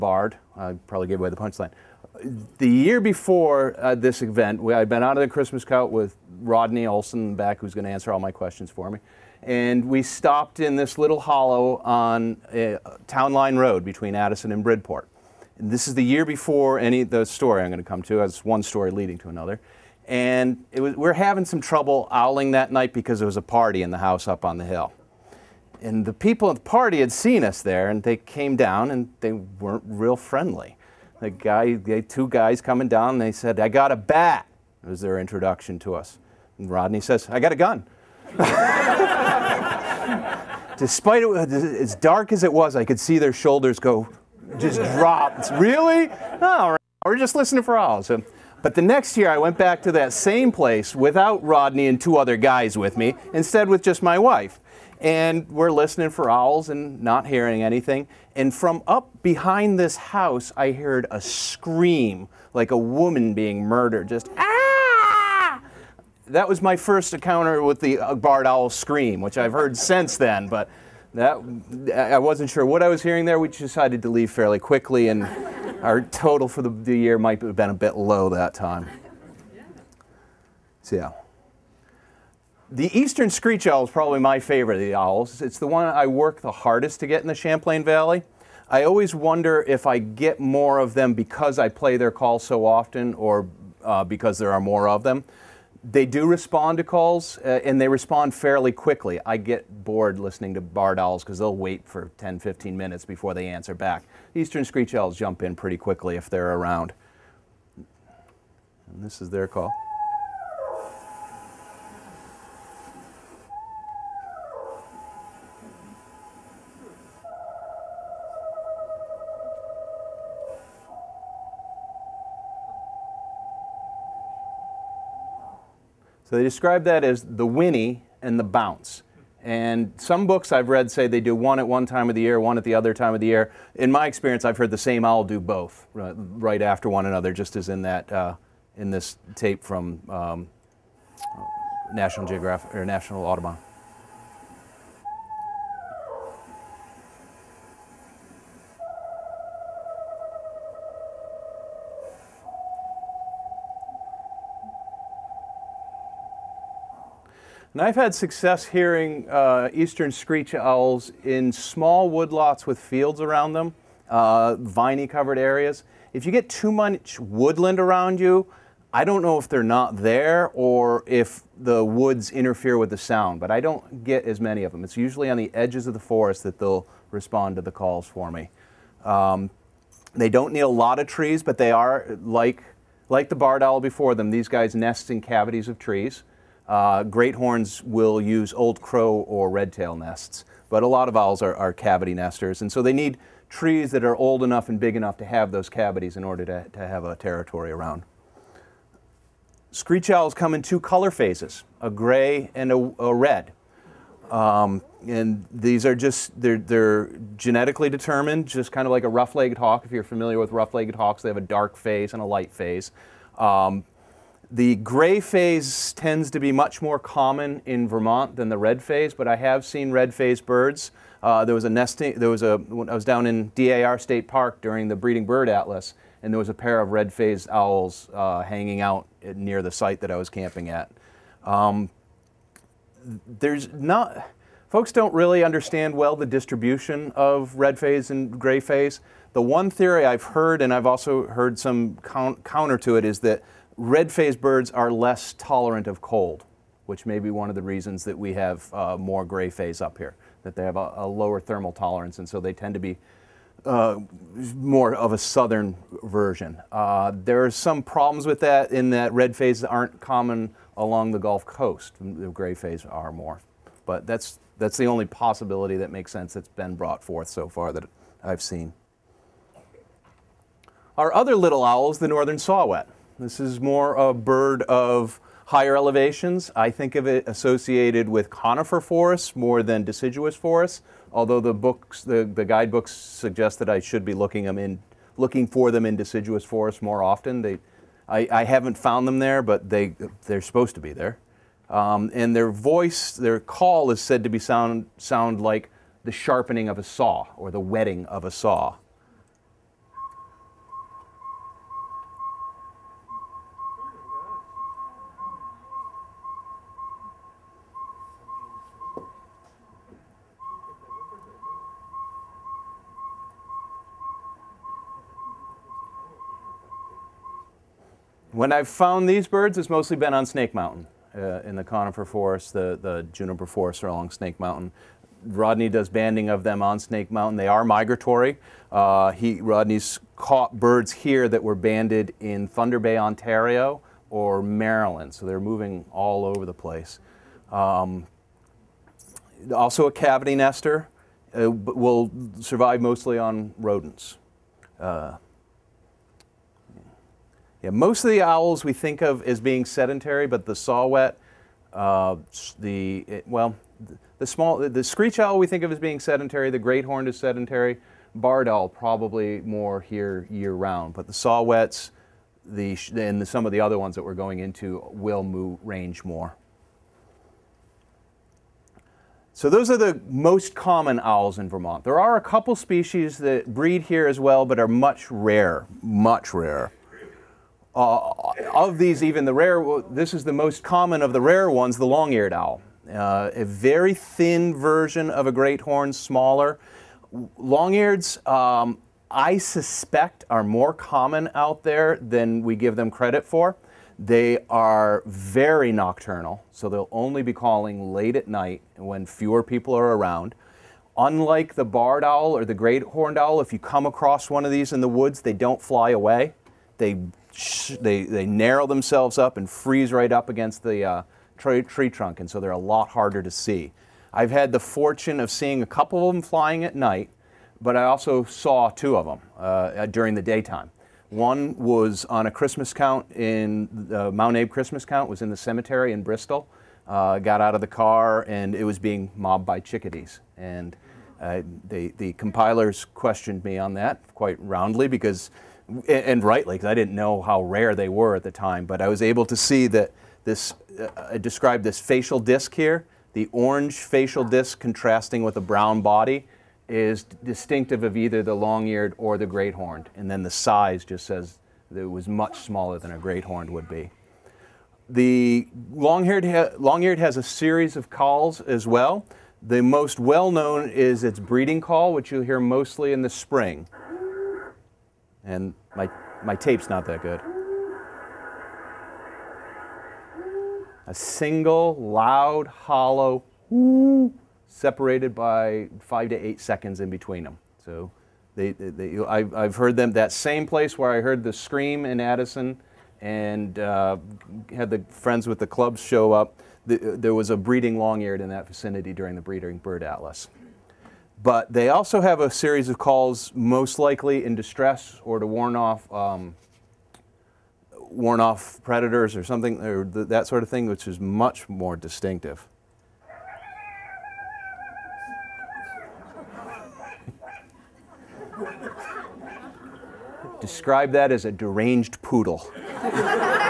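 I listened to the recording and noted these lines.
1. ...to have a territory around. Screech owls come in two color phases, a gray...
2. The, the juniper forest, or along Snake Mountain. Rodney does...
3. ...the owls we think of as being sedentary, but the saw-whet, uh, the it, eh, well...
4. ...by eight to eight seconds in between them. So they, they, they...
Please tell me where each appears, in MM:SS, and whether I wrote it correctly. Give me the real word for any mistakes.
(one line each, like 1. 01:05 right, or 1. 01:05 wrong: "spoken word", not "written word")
1. 03:16 right
2. 05:22 right
3. 05:48 right
4. 07:55 wrong: "five", not "eight".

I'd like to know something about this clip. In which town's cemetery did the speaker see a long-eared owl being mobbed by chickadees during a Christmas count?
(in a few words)
Bristol.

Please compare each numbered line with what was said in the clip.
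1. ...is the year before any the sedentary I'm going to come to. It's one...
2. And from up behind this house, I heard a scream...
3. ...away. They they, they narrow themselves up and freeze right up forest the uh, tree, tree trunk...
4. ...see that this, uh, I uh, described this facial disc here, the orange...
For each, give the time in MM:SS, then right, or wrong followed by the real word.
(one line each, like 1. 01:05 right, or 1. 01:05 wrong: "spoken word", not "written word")
1. 00:15 wrong: "story", not "sedentary"
2. 00:58 right
3. 06:45 wrong: "against", not "forest"
4. 07:19 right.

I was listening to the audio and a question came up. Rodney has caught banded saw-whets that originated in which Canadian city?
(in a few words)
Thunder Bay, Ontario.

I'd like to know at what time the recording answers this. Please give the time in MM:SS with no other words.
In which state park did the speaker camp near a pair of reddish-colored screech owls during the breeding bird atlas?
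03:43.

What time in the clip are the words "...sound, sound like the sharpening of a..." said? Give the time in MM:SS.
04:54.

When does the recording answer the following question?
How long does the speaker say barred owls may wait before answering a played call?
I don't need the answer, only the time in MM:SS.
01:42.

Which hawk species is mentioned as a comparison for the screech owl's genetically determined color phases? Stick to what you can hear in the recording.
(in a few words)
rough-legged hawk.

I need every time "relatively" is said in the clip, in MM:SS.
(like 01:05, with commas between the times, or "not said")
not said.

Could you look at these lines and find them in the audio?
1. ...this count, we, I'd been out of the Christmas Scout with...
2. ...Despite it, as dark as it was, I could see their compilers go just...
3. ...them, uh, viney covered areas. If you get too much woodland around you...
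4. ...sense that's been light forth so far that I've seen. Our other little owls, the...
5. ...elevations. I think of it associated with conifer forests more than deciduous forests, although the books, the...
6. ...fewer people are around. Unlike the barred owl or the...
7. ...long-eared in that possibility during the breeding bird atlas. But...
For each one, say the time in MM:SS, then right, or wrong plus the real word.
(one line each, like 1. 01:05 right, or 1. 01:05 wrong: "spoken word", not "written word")
1. 00:03 wrong: "event", not "count"
2. 00:40 wrong: "shoulders", not "compilers"
3. 02:43 right
4. 04:26 wrong: "brought", not "light"
5. 04:35 right
6. 06:39 right
7. 08:07 wrong: "vicinity", not "possibility".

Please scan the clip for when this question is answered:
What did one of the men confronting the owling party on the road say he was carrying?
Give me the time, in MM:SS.
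00:33.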